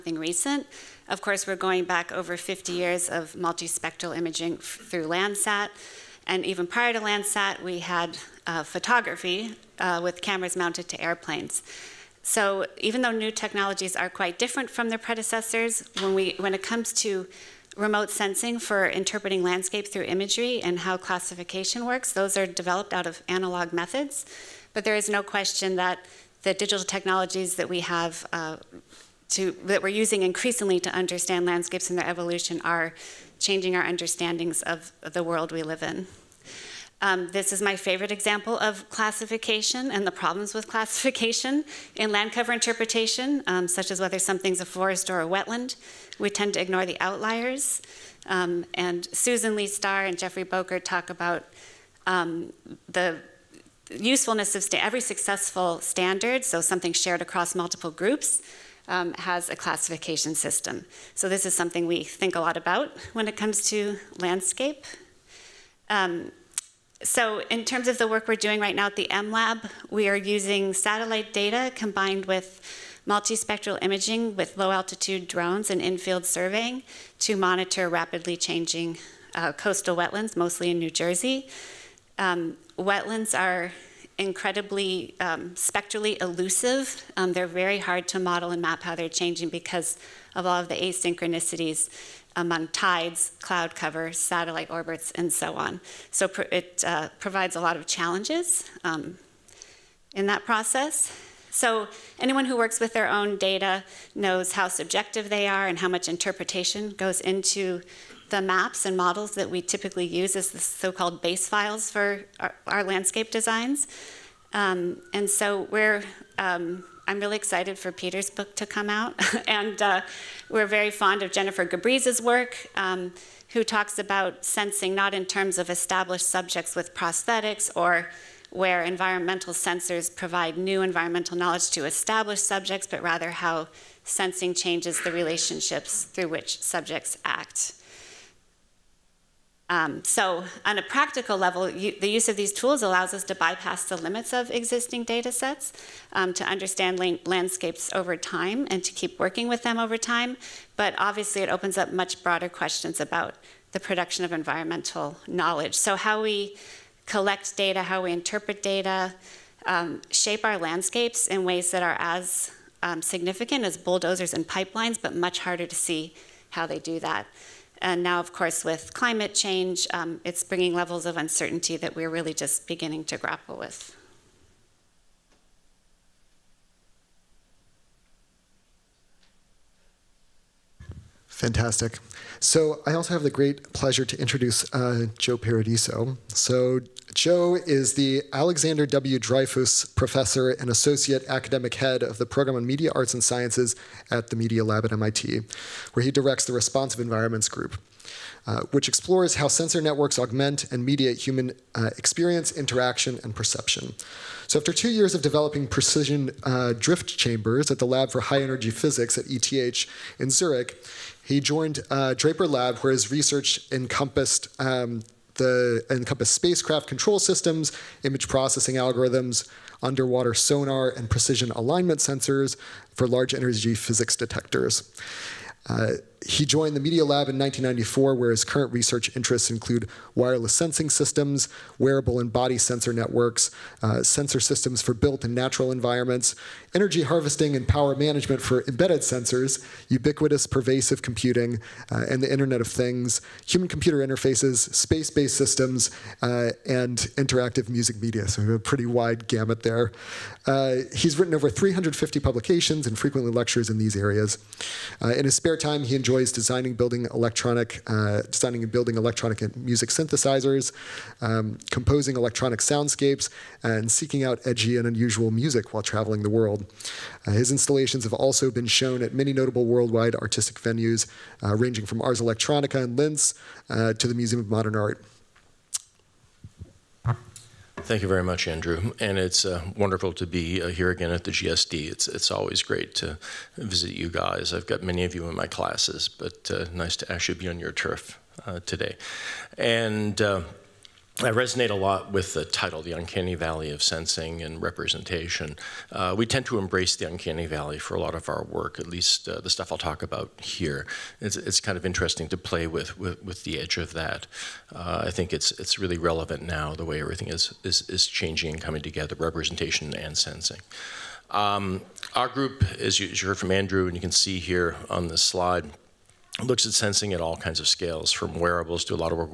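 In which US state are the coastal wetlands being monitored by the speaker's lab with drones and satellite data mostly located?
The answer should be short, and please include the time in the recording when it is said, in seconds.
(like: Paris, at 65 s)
New Jersey, at 80 s.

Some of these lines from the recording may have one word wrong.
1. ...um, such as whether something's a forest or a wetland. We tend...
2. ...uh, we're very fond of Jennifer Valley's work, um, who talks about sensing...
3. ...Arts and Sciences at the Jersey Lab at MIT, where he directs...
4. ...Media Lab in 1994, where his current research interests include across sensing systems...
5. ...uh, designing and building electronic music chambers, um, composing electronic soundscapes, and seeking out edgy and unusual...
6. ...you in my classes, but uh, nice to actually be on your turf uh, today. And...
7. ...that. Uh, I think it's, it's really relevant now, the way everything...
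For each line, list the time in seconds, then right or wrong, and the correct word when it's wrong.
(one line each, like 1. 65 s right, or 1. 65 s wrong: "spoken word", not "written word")
1. 43 s right
2. 119 s wrong: "Gabrys", not "Valley"
3. 192 s wrong: "Media", not "Jersey"
4. 226 s wrong: "wireless", not "across"
5. 257 s wrong: "synthesizers", not "chambers"
6. 285 s right
7. 303 s right.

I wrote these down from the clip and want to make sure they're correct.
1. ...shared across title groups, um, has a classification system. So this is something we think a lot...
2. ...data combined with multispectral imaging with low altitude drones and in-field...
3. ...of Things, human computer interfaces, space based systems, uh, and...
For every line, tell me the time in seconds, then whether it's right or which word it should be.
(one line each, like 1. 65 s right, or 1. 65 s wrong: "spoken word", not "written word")
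1. 56 s wrong: "multiple", not "title"
2. 71 s right
3. 242 s right.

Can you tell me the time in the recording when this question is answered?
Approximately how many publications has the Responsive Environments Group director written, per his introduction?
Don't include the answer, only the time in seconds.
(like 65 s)
251 s.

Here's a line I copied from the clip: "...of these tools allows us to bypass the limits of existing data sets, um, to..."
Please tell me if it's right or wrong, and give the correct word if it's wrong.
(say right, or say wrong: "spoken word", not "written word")
right.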